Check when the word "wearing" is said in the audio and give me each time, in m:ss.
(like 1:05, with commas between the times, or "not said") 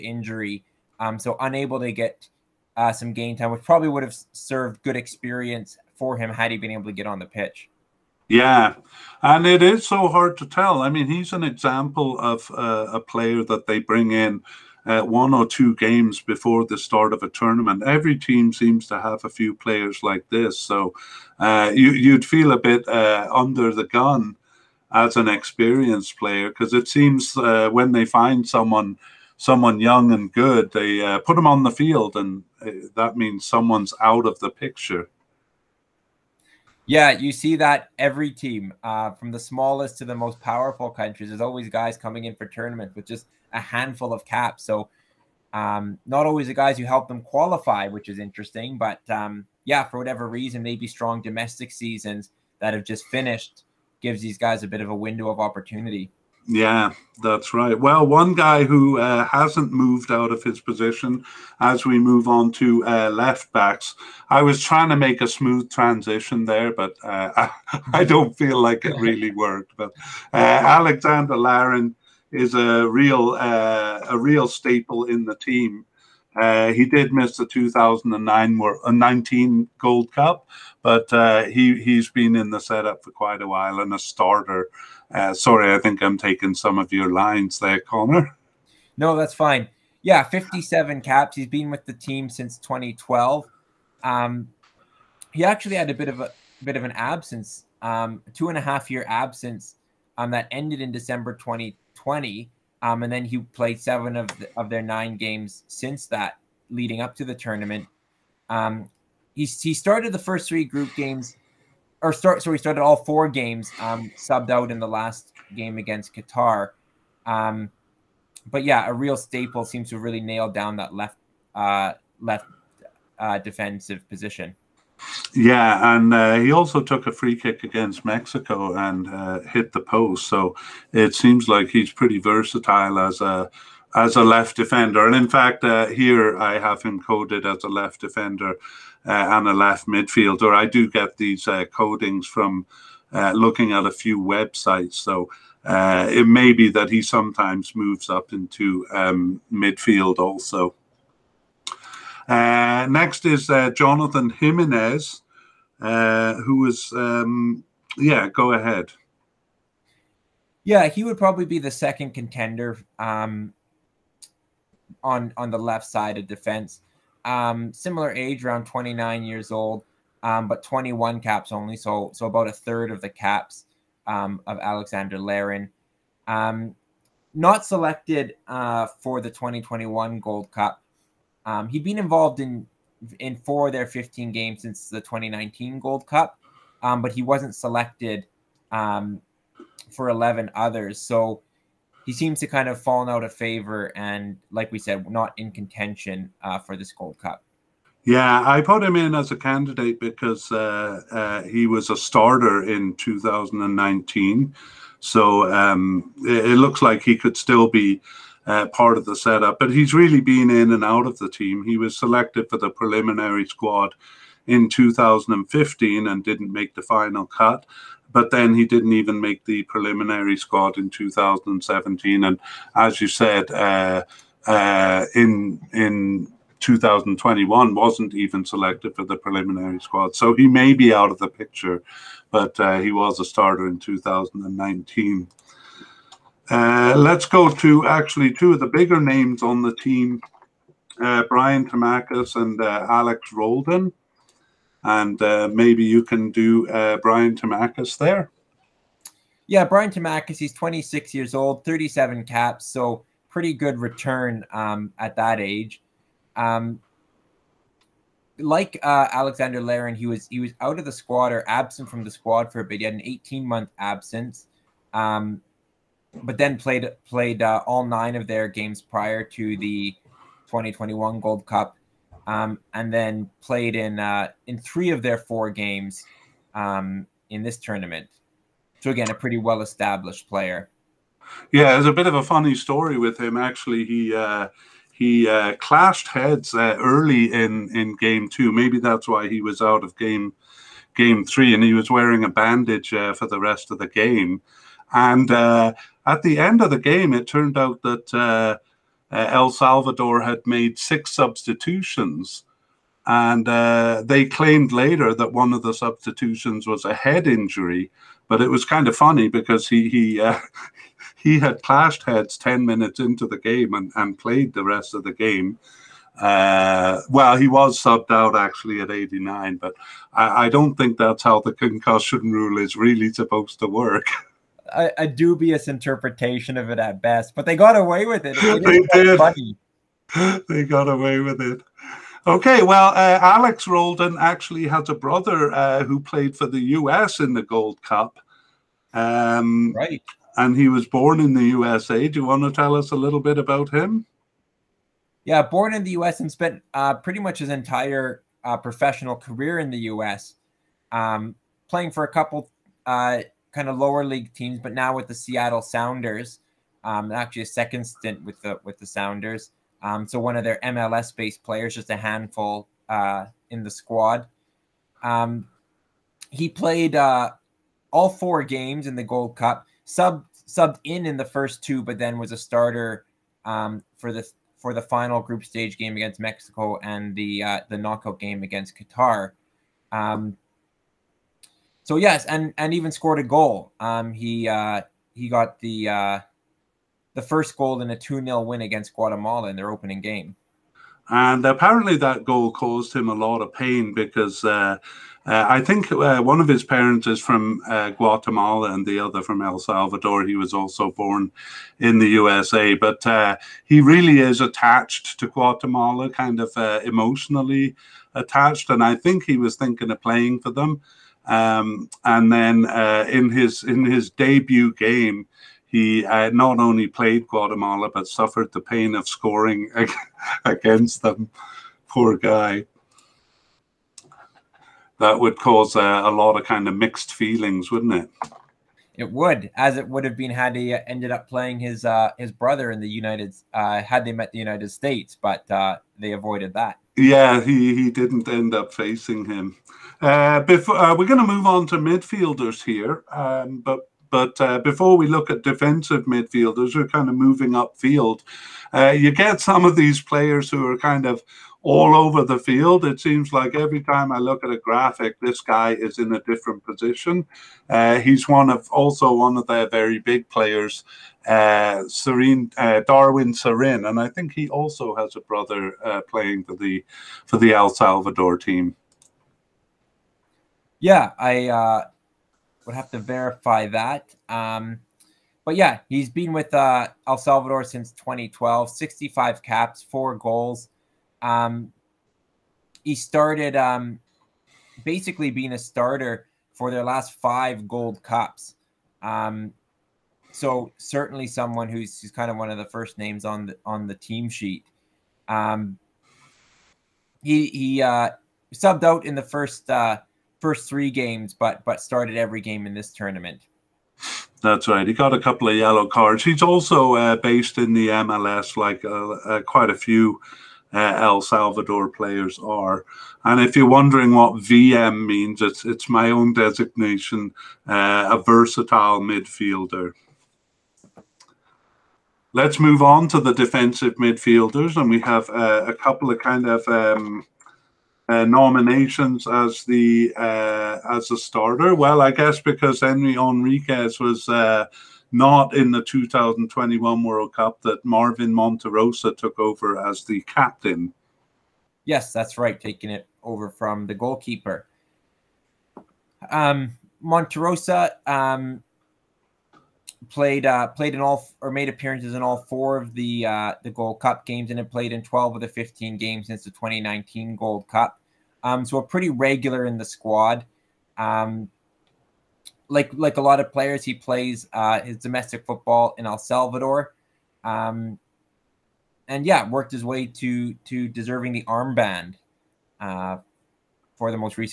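4:51.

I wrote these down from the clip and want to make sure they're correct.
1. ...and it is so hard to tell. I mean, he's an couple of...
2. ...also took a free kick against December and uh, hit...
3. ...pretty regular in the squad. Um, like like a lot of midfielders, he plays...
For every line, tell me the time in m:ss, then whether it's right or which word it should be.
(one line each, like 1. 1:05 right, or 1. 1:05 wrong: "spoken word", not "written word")
1. 0:09 wrong: "example", not "couple"
2. 2:06 wrong: "Mexico", not "December"
3. 9:18 wrong: "players", not "midfielders".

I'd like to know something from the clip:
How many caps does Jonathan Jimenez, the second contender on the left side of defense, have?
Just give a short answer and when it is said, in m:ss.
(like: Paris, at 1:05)
21, at 2:50.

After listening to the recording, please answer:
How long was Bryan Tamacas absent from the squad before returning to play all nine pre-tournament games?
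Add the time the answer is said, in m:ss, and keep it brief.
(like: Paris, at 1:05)
18 months, at 4:23.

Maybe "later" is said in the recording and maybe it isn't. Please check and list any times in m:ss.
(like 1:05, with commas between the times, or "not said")
5:04.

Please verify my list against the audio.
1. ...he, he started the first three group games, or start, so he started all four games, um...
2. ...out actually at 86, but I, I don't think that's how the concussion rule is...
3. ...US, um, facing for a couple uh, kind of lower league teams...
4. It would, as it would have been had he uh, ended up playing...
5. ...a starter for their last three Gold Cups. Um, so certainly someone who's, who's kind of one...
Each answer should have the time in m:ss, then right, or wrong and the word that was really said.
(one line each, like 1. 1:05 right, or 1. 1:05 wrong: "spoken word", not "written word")
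1. 1:49 right
2. 5:18 wrong: "89", not "86"
3. 5:49 wrong: "playing", not "facing"
4. 7:08 right
5. 8:05 wrong: "five", not "three".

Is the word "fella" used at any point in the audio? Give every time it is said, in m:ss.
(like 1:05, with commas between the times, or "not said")
not said.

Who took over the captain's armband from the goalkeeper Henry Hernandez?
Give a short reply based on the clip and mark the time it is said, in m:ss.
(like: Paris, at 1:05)
Marvin Monterroza, at 8:57.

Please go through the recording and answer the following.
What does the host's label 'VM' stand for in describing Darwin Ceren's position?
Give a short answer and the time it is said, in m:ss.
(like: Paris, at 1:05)
versatile midfielder, at 8:38.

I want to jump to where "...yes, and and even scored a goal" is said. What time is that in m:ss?
6:21.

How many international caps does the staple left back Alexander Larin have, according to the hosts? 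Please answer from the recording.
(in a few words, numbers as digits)
57.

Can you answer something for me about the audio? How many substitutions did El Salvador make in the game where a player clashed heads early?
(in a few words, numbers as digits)
6.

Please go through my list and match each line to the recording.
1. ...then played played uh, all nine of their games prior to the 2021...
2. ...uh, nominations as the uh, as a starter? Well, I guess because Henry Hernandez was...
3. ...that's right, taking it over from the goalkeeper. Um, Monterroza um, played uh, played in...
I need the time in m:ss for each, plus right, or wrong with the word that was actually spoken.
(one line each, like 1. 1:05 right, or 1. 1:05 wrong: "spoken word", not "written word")
1. 4:26 right
2. 8:48 right
3. 9:02 right.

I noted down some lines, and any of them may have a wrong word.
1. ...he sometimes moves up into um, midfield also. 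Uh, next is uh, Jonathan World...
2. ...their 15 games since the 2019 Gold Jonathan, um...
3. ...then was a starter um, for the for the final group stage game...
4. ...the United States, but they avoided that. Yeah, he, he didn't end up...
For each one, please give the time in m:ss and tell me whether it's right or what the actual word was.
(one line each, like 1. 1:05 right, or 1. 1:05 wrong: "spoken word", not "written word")
1. 2:26 wrong: "Jimenez", not "World"
2. 3:03 wrong: "Cup", not "Jonathan"
3. 6:11 right
4. 7:14 right.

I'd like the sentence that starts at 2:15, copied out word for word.
And in fact, uh, here I have him coded as a left defender uh, and a left midfielder.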